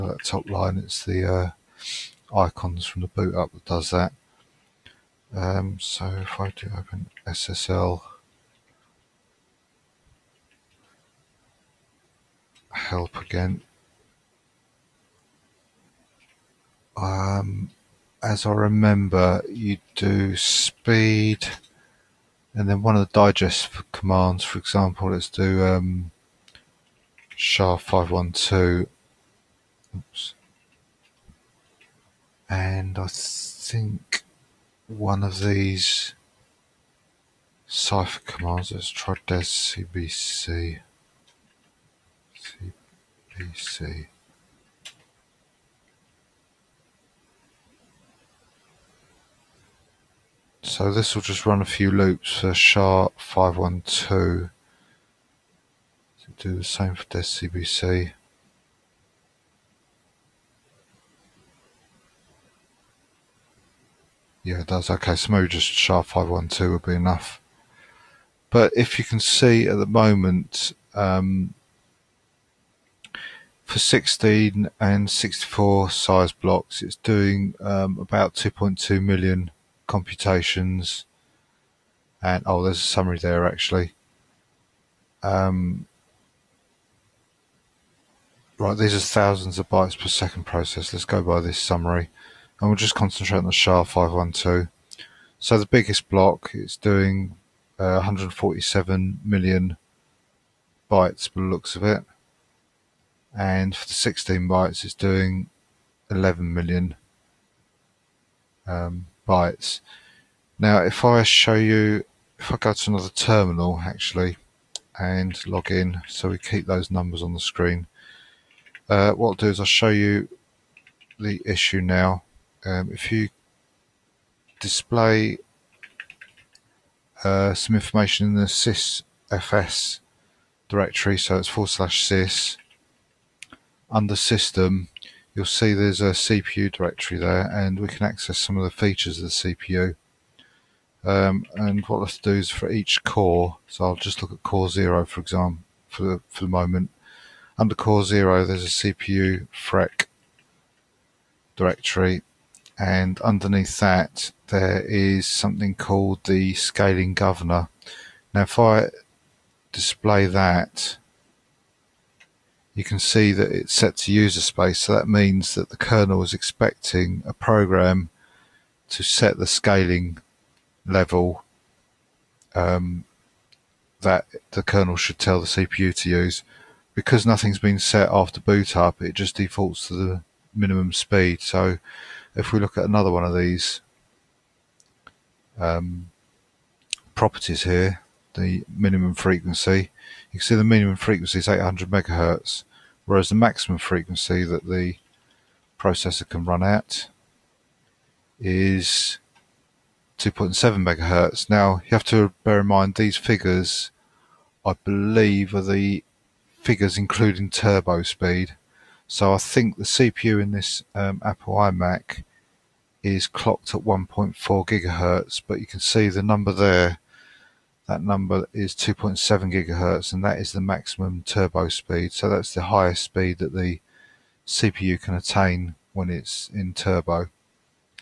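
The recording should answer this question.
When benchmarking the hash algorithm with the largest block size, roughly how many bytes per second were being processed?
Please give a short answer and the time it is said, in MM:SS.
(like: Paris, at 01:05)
147 million, at 01:37.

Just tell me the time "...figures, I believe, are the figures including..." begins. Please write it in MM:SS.
03:23.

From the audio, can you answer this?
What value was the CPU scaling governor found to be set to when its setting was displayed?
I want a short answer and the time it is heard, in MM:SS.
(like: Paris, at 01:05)
user space, at 02:44.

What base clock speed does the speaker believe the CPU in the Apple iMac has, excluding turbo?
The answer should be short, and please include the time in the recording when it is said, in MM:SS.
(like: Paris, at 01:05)
1.4 gigahertz, at 03:33.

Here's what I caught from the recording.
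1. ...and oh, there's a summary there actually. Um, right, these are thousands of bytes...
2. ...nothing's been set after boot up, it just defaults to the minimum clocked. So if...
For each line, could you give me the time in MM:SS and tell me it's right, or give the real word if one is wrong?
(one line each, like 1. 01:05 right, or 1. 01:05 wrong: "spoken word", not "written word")
1. 01:22 right
2. 02:57 wrong: "speed", not "clocked".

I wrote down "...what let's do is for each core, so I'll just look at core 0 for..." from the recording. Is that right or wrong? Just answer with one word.
right.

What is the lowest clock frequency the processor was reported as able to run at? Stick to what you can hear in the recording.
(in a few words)
800 megahertz.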